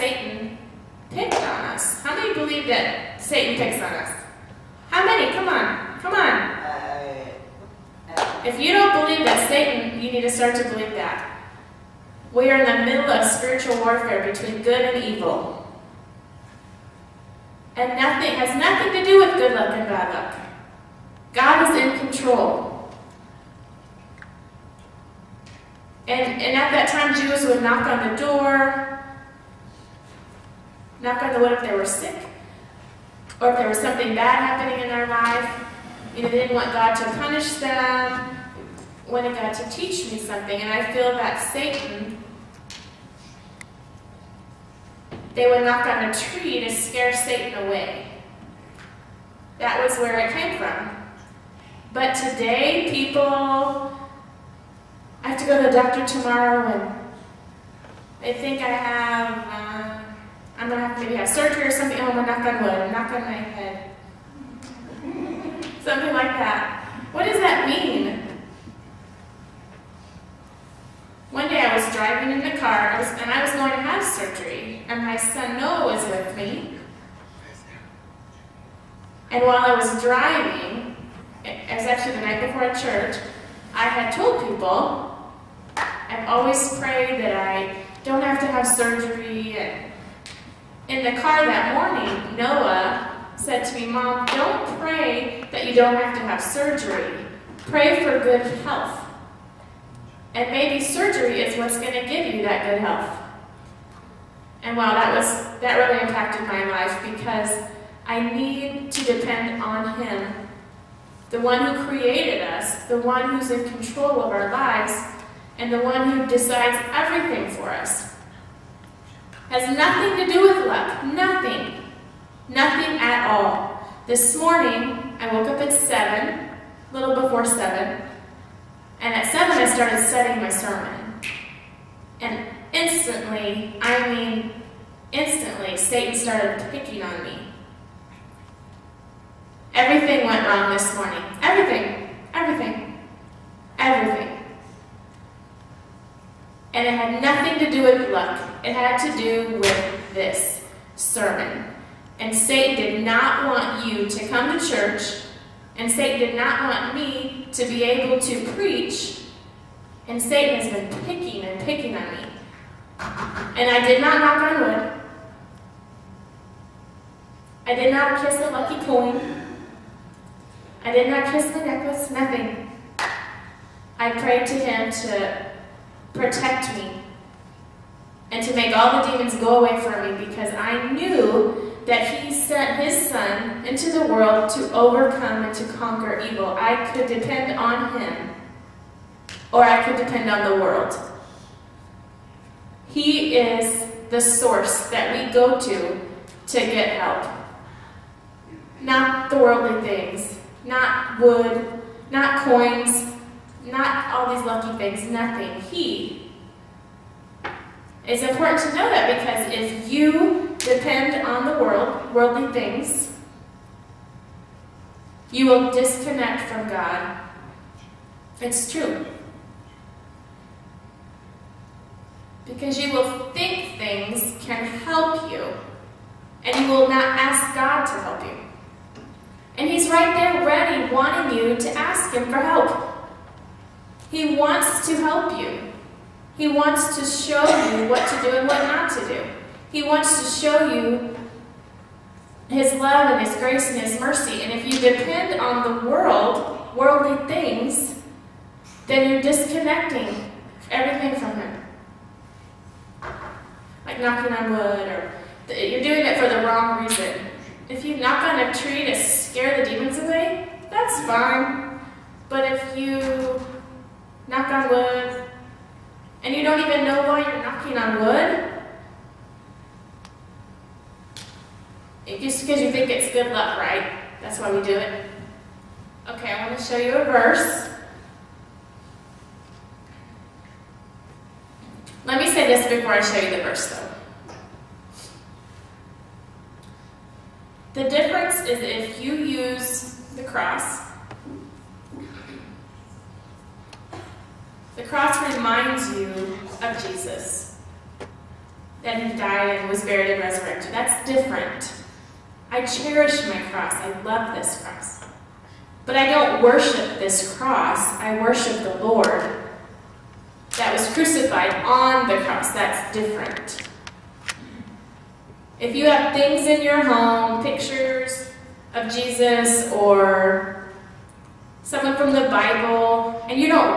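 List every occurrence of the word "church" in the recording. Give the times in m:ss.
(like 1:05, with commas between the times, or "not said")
1:22, 2:34.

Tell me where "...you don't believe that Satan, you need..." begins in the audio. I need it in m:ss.
0:08.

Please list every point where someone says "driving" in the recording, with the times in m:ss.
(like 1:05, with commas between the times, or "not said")
1:11, 1:20.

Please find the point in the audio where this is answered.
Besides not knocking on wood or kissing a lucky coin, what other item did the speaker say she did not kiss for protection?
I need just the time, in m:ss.
2:51.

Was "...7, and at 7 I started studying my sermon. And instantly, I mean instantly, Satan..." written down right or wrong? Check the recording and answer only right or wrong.
right.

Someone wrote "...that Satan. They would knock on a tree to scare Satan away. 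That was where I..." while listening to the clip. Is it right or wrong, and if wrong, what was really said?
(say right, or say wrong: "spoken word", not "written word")
right.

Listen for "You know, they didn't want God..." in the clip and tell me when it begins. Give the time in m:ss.
0:36.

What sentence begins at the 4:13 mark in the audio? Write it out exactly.
Like knocking on wood, or you're doing it for the wrong reason.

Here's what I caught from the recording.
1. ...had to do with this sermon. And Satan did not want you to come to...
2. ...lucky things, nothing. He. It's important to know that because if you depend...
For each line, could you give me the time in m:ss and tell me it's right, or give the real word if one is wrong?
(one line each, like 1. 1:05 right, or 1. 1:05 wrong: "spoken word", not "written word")
1. 2:28 right
2. 3:24 right.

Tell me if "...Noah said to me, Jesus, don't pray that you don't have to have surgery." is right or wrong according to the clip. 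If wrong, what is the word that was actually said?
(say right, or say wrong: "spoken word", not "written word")
wrong: "Mom", not "Jesus".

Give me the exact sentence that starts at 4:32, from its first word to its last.
It just because you think it's good luck, right?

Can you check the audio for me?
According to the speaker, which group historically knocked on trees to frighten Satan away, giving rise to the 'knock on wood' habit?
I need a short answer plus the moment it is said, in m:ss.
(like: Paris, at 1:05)
Jews, at 0:27.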